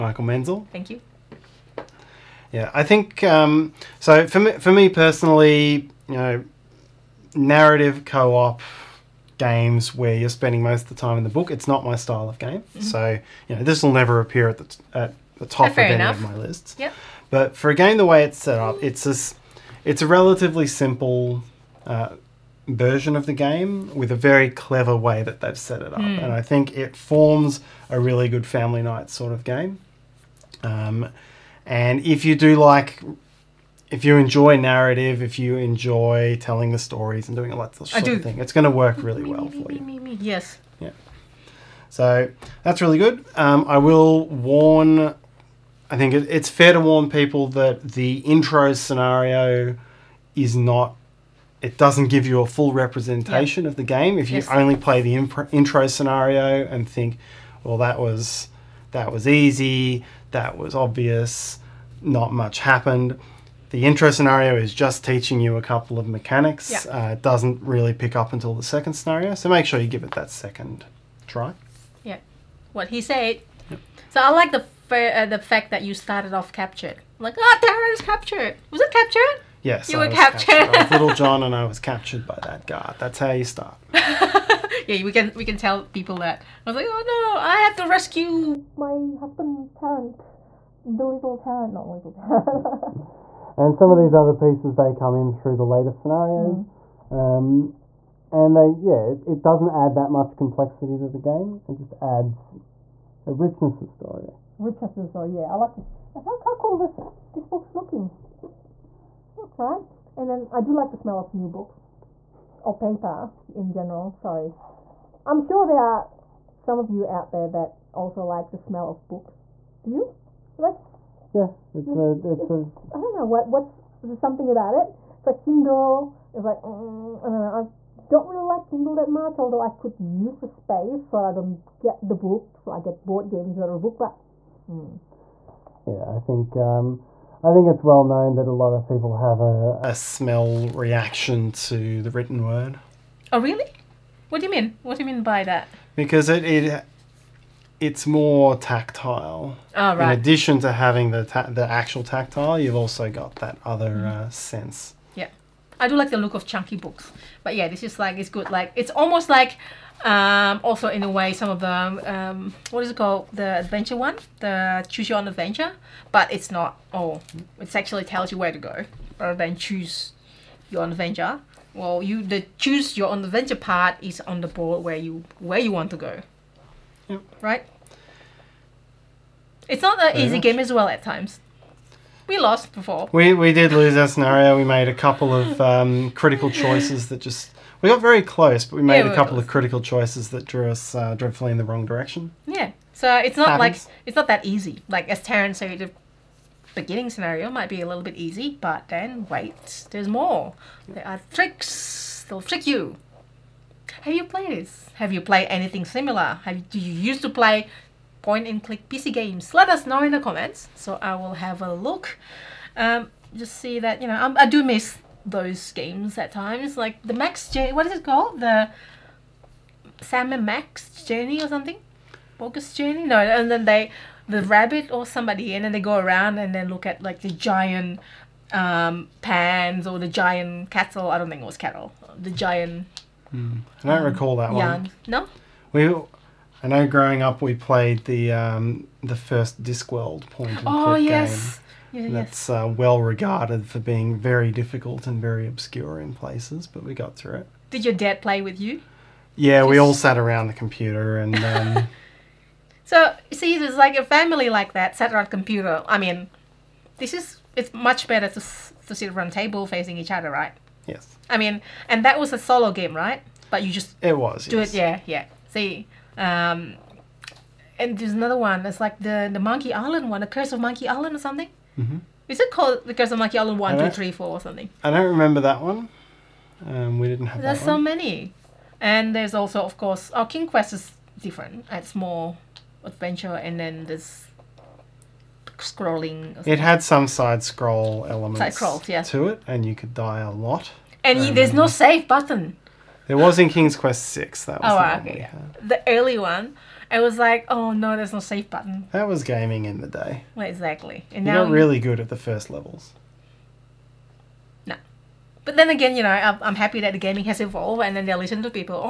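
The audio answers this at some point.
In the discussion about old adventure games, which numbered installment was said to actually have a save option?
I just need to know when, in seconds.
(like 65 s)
293 s.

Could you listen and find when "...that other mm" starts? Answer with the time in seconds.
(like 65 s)
153 s.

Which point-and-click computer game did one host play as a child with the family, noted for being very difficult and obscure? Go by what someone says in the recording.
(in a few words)
Discworld.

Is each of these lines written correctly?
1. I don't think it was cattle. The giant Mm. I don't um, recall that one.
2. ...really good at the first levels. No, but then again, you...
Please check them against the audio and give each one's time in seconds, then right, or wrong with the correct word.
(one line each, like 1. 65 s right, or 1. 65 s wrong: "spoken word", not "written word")
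1. 231 s right
2. 301 s right.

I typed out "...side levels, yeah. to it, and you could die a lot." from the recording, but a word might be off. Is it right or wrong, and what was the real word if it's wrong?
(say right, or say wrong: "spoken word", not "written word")
wrong: "scrolls", not "levels".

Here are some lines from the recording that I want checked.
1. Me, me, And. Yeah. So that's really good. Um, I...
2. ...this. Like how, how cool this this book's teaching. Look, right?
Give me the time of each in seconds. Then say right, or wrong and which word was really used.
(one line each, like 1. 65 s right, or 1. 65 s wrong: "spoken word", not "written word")
1. 39 s wrong: "Yes", not "And"
2. 105 s wrong: "looking", not "teaching".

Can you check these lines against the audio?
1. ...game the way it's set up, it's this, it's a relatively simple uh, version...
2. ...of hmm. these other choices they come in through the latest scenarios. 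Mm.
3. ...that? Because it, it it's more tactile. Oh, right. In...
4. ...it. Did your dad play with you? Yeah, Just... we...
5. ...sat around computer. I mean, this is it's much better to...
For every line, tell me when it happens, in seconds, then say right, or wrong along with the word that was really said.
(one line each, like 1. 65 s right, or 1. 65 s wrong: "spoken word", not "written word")
1. 17 s right
2. 93 s wrong: "pieces", not "choices"
3. 145 s right
4. 247 s right
5. 254 s right.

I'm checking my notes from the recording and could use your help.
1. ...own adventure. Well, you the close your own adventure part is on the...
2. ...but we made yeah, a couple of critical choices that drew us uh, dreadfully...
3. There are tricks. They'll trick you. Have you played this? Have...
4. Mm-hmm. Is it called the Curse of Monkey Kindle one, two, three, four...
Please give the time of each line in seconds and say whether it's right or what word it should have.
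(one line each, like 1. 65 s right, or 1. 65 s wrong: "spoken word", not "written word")
1. 170 s wrong: "choose", not "close"
2. 188 s right
3. 200 s right
4. 271 s wrong: "Island", not "Kindle".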